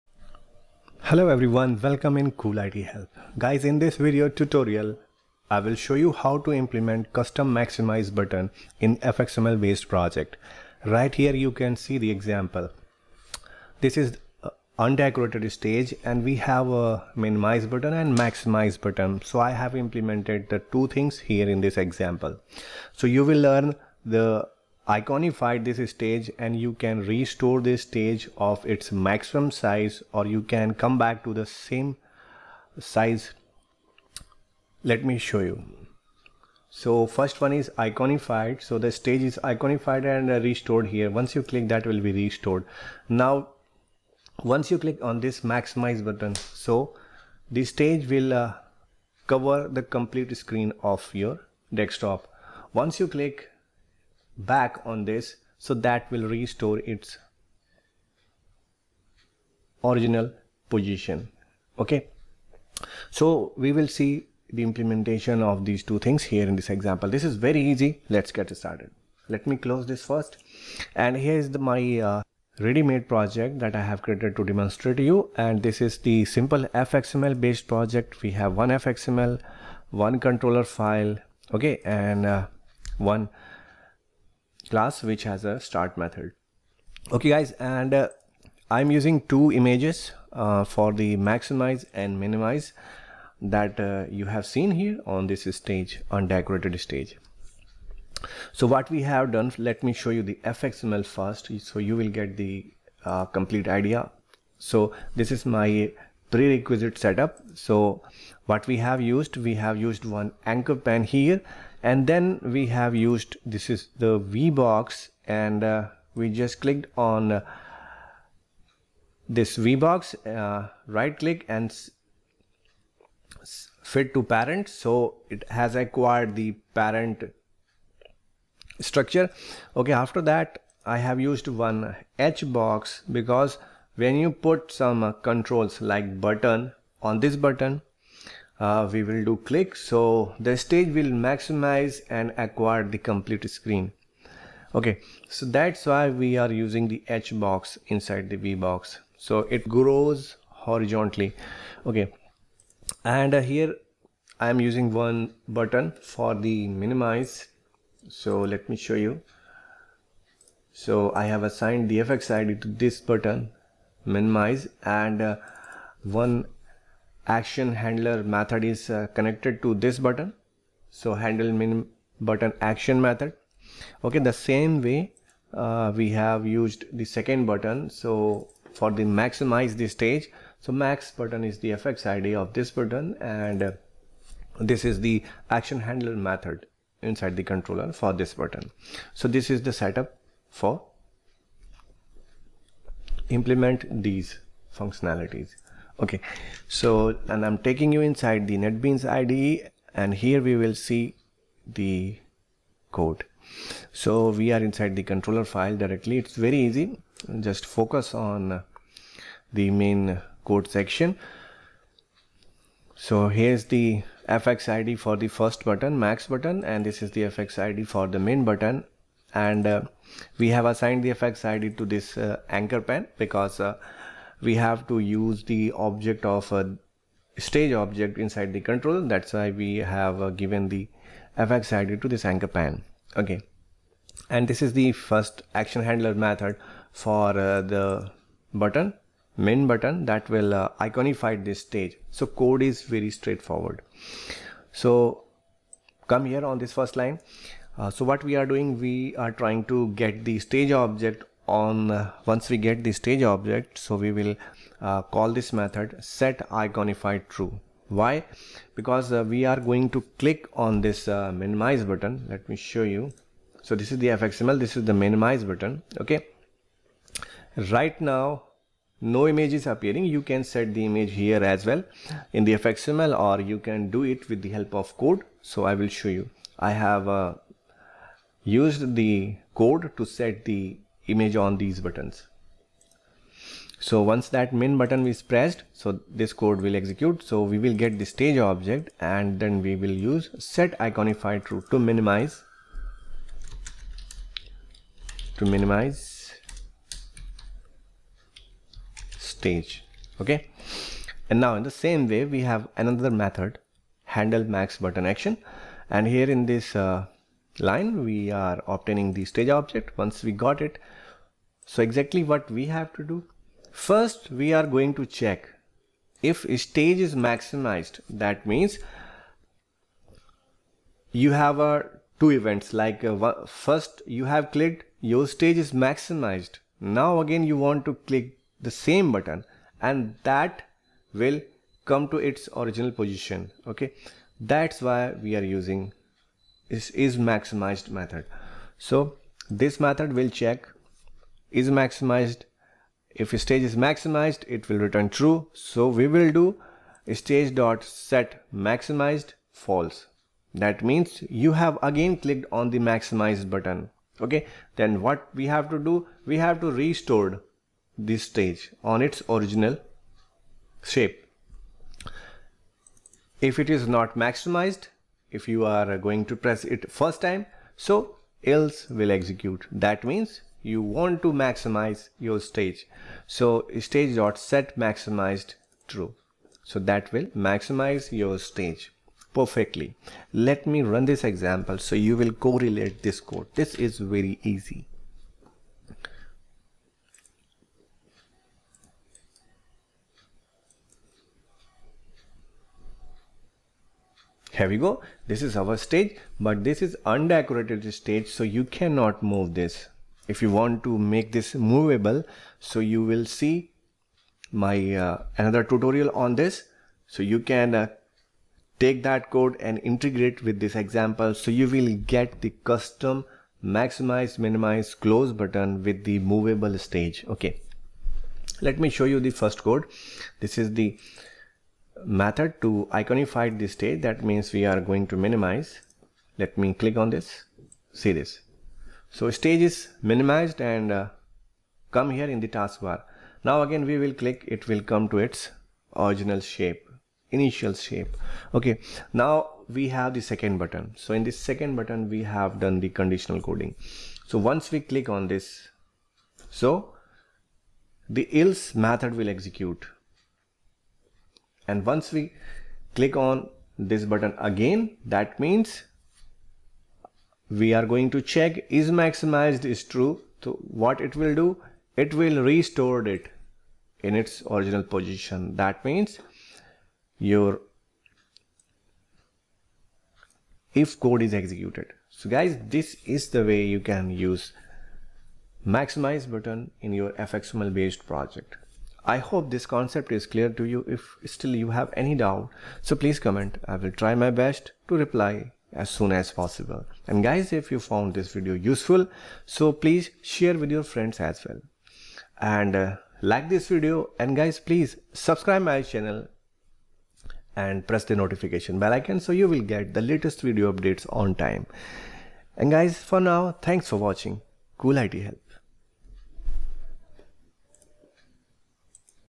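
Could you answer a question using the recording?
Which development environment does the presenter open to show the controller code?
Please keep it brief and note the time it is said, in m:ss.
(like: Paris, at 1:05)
NetBeans, at 3:18.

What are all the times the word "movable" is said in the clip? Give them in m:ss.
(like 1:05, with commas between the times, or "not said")
6:41, 6:56.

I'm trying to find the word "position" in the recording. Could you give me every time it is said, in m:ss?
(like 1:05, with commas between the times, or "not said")
1:00, 5:32, 7:44.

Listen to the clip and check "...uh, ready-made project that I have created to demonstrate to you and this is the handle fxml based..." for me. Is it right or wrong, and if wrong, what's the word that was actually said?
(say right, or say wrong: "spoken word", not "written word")
wrong: "simple", not "handle".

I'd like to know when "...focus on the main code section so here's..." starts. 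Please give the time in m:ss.
3:27.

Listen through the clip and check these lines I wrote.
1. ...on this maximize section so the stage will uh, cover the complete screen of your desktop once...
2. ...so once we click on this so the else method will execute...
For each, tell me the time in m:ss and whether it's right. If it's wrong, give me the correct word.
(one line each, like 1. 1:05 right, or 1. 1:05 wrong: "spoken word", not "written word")
1. 0:45 wrong: "button", not "section"
2. 7:24 right.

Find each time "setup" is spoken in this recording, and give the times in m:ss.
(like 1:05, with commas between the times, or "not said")
1:46, 3:09.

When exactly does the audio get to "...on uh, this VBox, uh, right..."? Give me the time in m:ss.
1:56.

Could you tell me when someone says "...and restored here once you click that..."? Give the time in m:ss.
0:40.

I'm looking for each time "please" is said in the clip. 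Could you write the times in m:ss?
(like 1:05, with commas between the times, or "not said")
8:02, 8:09, 8:14.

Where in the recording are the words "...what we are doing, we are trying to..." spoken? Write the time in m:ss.
4:08.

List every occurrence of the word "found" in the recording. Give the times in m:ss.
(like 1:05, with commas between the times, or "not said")
8:07.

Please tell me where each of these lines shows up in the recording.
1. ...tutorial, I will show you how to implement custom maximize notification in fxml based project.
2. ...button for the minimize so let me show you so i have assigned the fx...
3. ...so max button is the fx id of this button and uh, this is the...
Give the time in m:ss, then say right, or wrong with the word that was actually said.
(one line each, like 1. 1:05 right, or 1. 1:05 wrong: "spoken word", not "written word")
1. 0:04 wrong: "button", not "notification"
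2. 2:35 right
3. 3:00 right.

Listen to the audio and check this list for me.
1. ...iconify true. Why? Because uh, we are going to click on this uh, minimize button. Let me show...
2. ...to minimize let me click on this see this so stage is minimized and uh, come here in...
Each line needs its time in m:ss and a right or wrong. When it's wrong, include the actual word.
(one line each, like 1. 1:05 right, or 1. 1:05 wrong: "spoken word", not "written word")
1. 4:16 right
2. 7:05 right.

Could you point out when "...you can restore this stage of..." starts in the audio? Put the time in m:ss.
0:26.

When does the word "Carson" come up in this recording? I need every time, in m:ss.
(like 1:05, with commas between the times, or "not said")
not said.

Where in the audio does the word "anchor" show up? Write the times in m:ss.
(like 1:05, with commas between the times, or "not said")
1:50, 3:42, 3:52.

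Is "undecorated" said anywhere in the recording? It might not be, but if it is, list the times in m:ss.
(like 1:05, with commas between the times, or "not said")
0:14, 1:36, 6:37.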